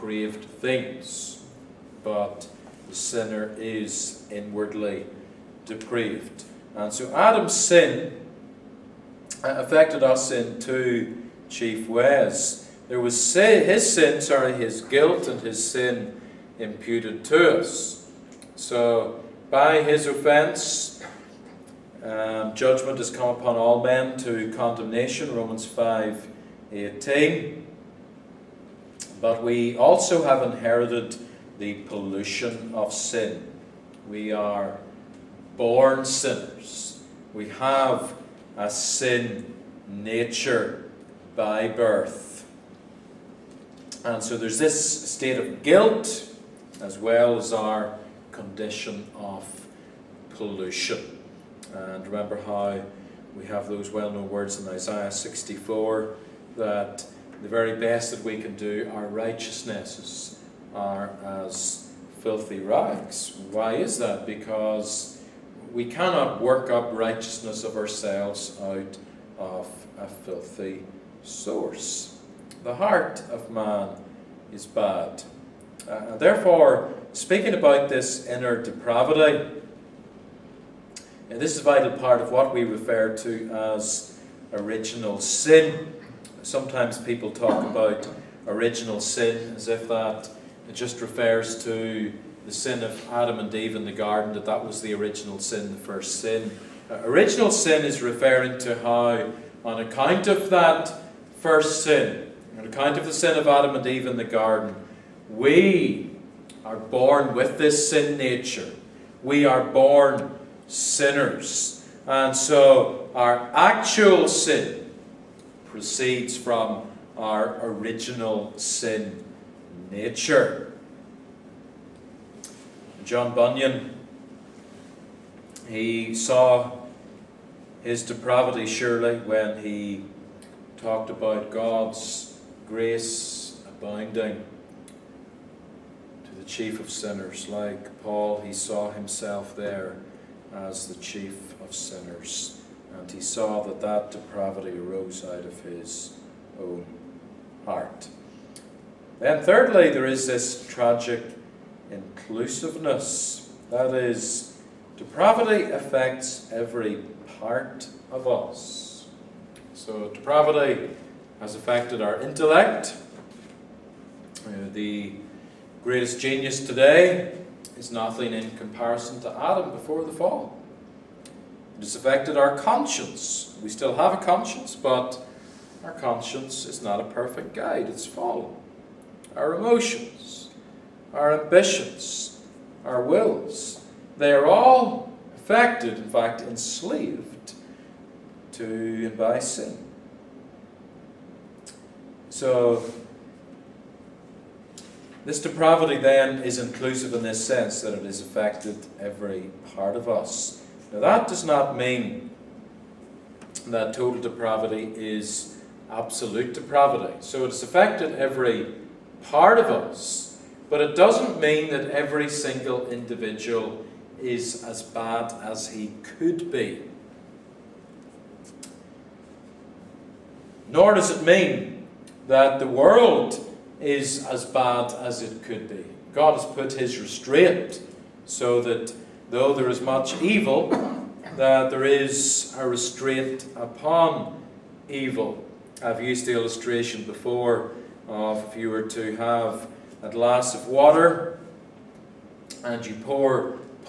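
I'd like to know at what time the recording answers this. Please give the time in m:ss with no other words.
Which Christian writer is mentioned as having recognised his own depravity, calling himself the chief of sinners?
2:03.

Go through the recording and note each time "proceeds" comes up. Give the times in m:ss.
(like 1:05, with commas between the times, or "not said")
1:55.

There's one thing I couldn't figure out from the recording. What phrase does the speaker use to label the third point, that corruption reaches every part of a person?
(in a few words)
tragic inclusiveness.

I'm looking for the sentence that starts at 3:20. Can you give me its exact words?
Now that does not mean that total depravity is absolute depravity.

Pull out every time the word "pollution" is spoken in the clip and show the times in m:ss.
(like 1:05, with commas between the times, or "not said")
0:31, 0:50.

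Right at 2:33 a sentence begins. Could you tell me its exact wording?
That is, depravity affects every part of us.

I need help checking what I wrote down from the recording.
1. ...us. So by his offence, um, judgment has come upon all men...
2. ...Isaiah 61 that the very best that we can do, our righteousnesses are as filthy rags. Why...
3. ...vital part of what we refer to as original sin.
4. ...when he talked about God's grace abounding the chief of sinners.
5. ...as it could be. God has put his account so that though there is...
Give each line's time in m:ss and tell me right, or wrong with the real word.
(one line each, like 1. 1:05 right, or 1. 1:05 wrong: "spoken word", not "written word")
1. 0:17 right
2. 0:54 wrong: "64", not "61"
3. 1:21 right
4. 2:09 right
5. 3:44 wrong: "restraint", not "account".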